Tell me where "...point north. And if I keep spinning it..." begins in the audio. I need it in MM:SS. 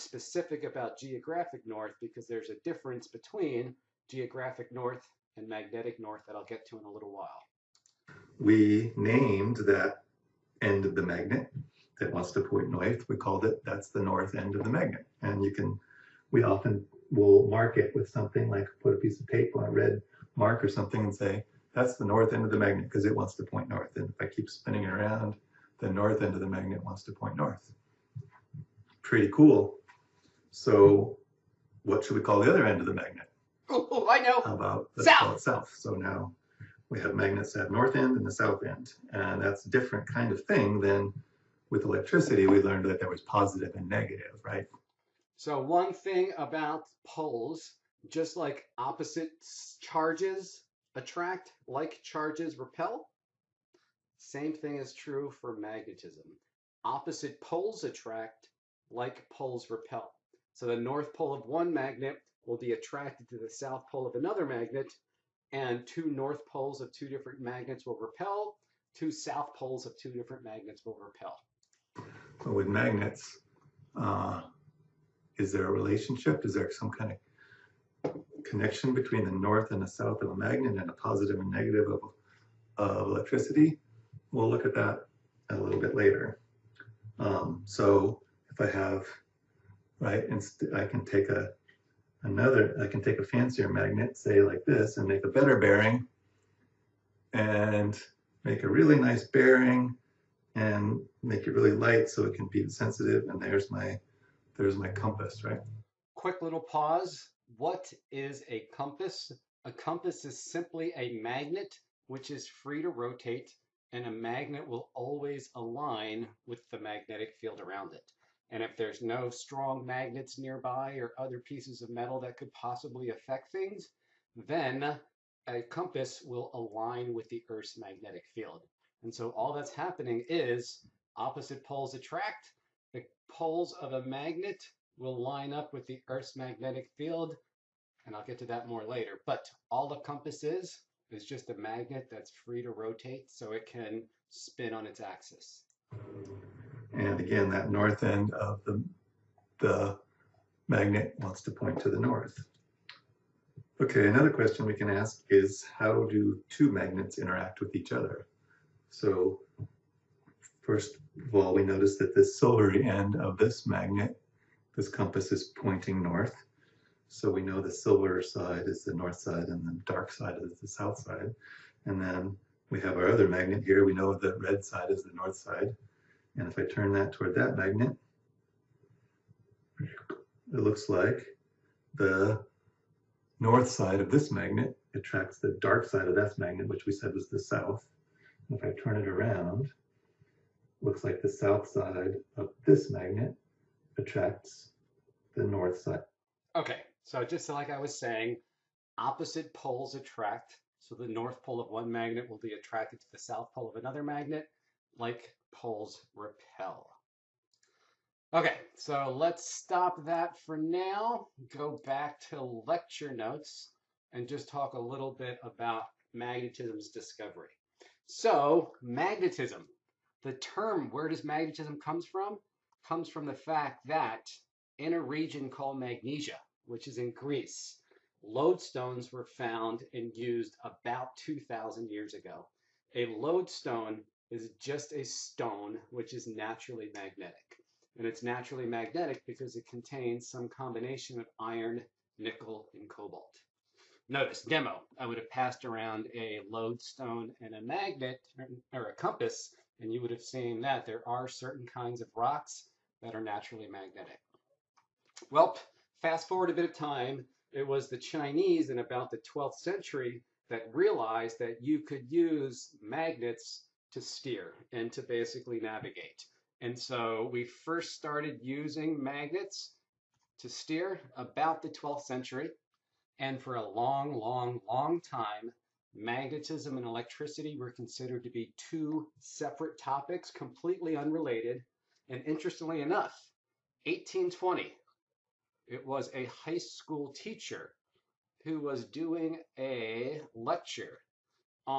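00:23.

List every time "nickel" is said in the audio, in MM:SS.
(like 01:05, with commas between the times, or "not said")
04:02.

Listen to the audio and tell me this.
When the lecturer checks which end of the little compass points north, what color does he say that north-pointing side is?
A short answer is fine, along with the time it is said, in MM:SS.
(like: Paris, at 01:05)
silver, at 02:47.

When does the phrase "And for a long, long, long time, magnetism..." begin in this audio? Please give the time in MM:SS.
04:33.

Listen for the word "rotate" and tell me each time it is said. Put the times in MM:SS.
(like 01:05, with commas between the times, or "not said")
01:52, 02:22.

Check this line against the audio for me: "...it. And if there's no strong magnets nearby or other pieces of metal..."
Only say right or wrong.
right.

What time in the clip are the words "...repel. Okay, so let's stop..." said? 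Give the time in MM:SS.
03:26.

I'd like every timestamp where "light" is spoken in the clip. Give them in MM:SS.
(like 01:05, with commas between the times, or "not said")
01:41.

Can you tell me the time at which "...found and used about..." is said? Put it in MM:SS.
03:49.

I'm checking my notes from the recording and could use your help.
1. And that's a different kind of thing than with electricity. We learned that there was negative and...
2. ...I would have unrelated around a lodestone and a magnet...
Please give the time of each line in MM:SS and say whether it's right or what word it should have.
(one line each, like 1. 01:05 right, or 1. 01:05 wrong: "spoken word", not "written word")
1. 00:39 wrong: "positive", not "negative"
2. 04:04 wrong: "passed", not "unrelated".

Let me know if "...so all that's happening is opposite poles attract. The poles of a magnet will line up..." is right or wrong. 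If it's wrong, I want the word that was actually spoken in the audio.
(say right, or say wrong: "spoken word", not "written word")
right.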